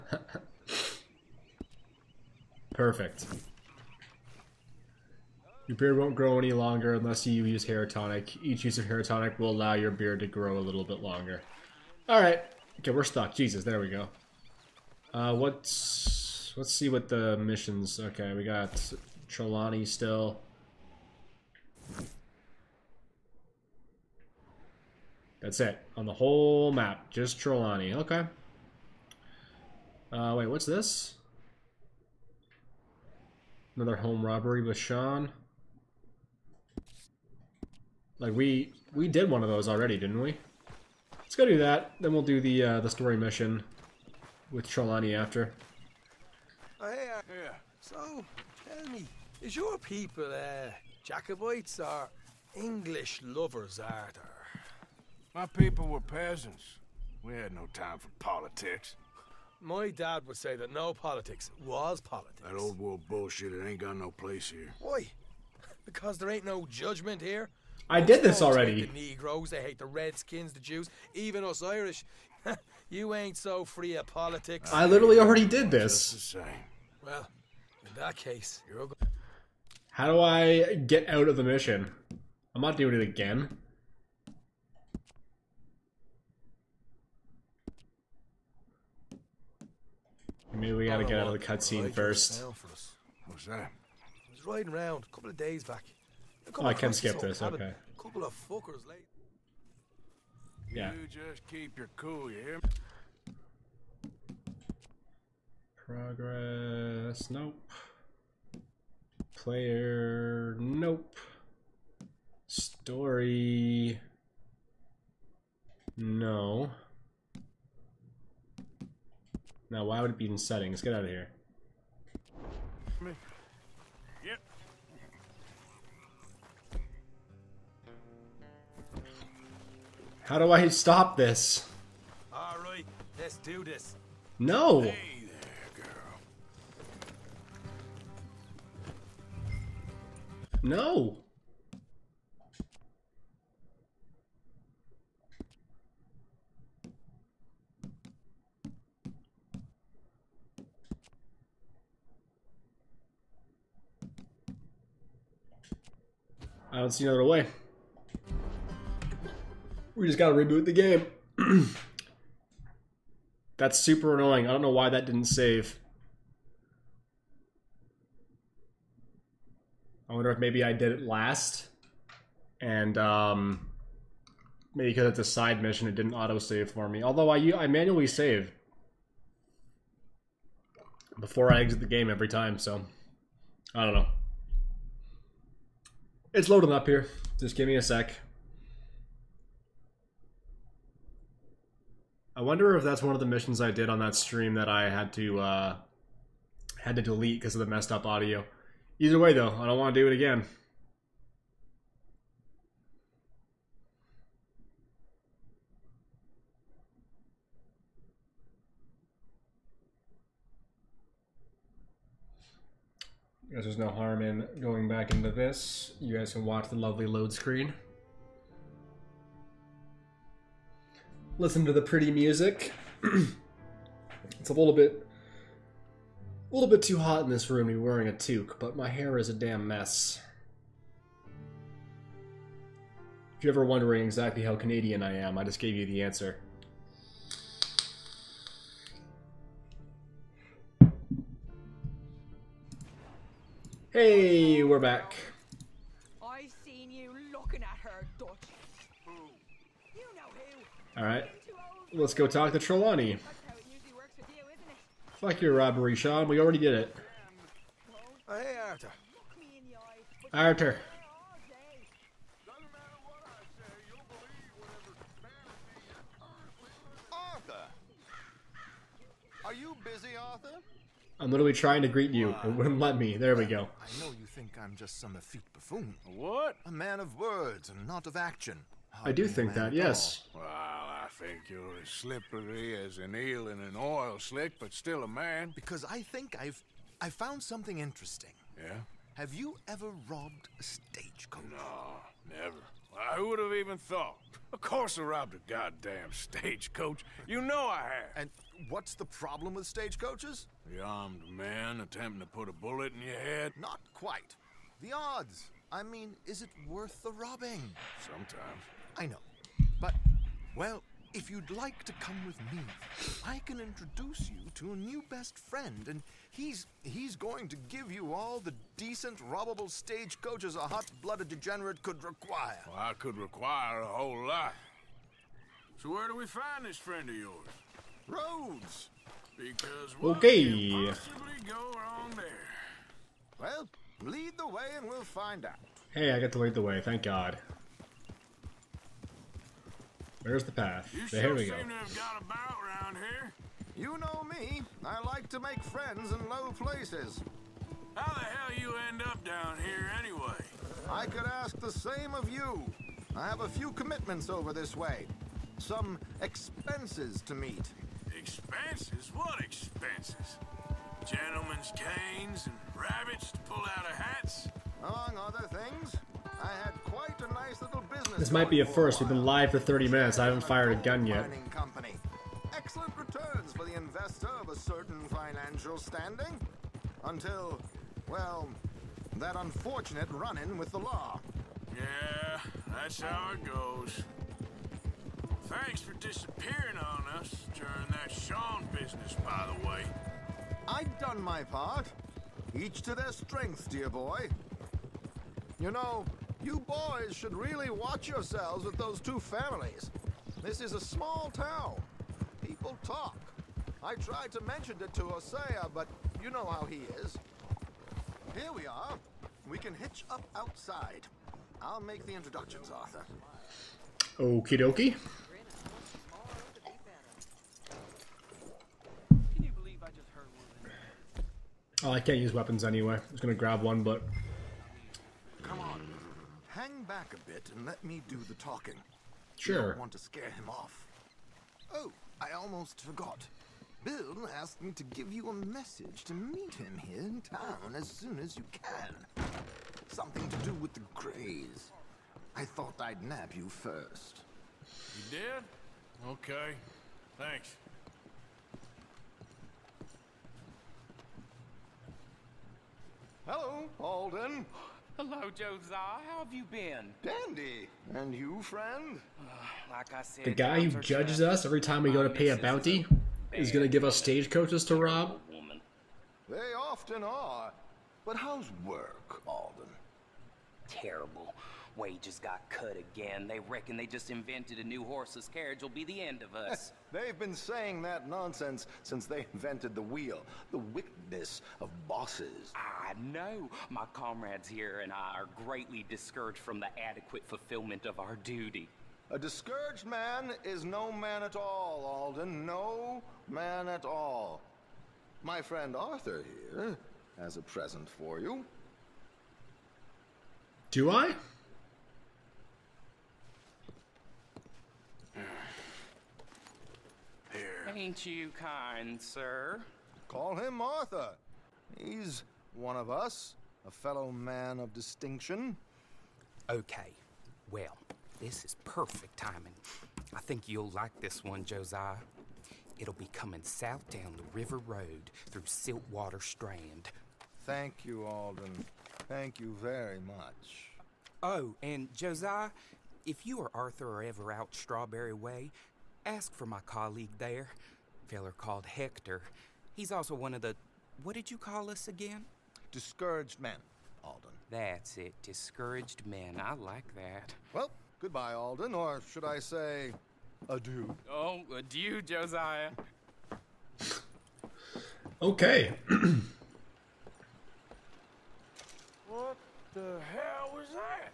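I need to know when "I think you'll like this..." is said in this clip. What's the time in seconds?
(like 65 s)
520 s.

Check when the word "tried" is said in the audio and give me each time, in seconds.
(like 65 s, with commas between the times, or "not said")
403 s.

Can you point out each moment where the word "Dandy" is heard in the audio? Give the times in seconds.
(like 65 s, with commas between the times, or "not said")
457 s.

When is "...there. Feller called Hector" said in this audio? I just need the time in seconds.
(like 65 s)
537 s.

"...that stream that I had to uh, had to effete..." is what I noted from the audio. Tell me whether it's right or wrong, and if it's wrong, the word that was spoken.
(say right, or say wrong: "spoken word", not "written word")
wrong: "delete", not "effete".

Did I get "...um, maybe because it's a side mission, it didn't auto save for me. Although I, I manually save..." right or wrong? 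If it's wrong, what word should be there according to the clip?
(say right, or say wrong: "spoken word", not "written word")
right.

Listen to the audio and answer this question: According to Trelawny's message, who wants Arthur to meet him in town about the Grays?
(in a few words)
Bill.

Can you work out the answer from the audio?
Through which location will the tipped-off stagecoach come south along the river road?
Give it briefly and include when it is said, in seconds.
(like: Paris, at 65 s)
Siltwater Strand, at 525 s.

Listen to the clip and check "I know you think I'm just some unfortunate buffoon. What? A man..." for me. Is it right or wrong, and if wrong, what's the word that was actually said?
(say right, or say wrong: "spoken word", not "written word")
wrong: "effete", not "unfortunate".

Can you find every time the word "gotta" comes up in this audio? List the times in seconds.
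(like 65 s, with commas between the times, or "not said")
90 s, 160 s.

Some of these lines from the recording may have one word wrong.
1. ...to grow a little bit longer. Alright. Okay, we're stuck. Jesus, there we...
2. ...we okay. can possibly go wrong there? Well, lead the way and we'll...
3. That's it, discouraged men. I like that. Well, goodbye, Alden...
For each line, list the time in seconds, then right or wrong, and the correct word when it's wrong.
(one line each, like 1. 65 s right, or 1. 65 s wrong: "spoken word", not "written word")
1. 10 s right
2. 329 s right
3. 544 s right.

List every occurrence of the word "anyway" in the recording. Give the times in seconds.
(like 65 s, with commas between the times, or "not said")
349 s, 422 s.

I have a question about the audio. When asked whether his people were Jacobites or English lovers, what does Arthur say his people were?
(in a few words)
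Peasants.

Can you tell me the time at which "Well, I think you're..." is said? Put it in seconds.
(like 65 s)
280 s.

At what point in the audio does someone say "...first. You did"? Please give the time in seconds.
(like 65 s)
443 s.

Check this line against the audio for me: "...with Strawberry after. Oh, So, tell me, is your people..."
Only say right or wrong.
wrong.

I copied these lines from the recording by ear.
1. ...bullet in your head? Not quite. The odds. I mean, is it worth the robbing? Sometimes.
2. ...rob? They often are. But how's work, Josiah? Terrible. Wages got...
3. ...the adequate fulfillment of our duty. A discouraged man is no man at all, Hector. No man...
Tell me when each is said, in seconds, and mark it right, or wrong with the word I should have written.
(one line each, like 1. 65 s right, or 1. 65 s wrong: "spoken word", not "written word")
1. 302 s right
2. 464 s wrong: "Alden", not "Josiah"
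3. 486 s wrong: "Alden", not "Hector".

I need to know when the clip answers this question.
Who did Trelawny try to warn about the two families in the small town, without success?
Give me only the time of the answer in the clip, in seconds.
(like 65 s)
405 s.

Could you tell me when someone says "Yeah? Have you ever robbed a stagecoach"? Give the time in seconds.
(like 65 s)
288 s.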